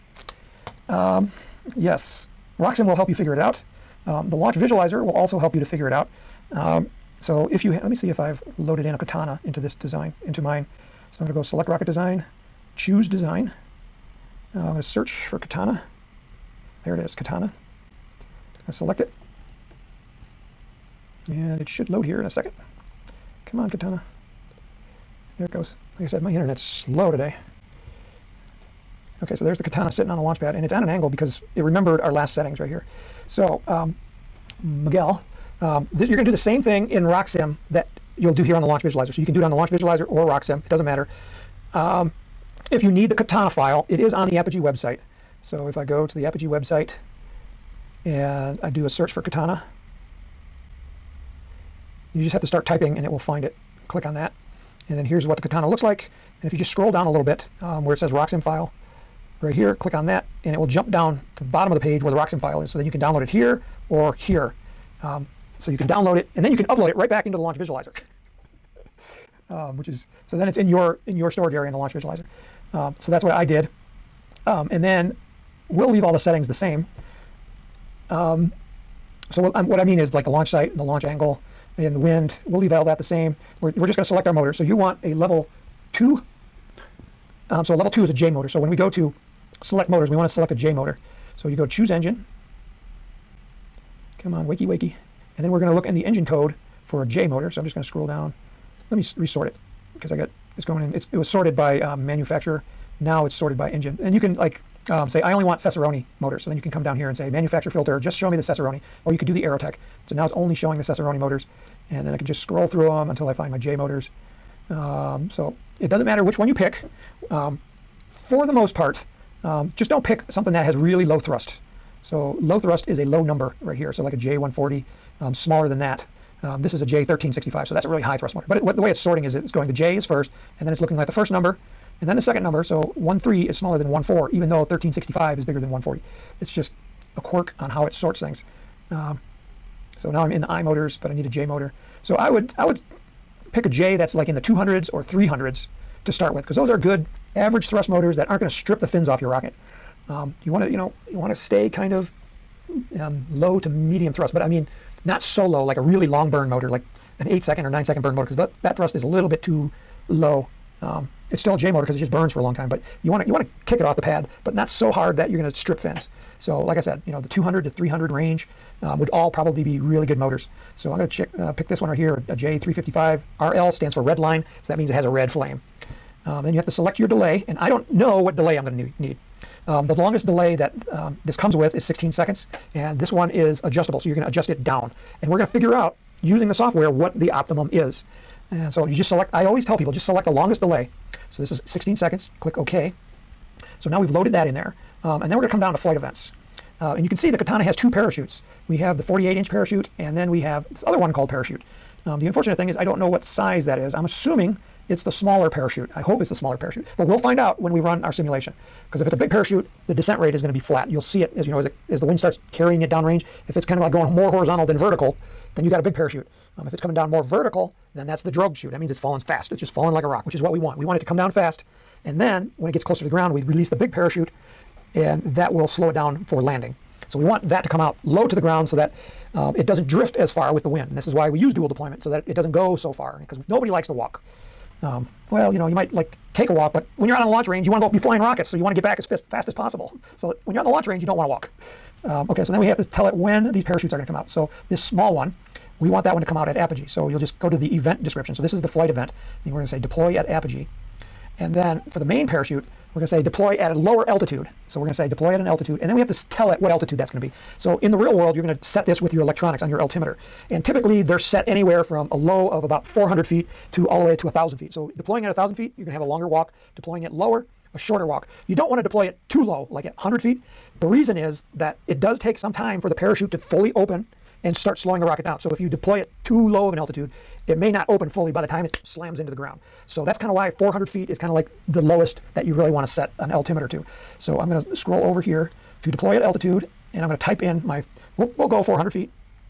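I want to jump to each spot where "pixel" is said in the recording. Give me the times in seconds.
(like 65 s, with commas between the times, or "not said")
not said.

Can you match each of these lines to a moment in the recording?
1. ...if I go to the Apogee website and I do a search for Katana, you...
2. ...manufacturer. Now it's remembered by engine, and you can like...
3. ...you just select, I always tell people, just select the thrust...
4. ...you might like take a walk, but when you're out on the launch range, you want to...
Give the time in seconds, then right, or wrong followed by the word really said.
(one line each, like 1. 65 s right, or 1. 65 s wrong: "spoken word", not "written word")
1. 45 s right
2. 102 s wrong: "sorted", not "remembered"
3. 188 s wrong: "longest", not "thrust"
4. 235 s right.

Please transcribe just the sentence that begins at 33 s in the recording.
So, um, Miguel, um, this, you're going to do the same thing in RockSim that you'll do here on the launch visualizer.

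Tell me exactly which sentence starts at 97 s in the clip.
So I'm just going to scroll down.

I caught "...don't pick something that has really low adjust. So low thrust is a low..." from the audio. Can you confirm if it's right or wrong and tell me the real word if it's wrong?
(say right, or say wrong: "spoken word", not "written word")
wrong: "thrust", not "adjust".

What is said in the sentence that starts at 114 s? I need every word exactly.
Um, so it doesn't matter which one you pick.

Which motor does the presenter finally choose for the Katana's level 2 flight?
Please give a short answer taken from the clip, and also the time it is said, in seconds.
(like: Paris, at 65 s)
J355, at 172 s.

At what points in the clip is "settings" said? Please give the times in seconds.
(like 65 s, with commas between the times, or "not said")
32 s, 76 s.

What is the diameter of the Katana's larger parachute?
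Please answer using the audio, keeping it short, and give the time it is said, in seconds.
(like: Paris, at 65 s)
48 inch, at 199 s.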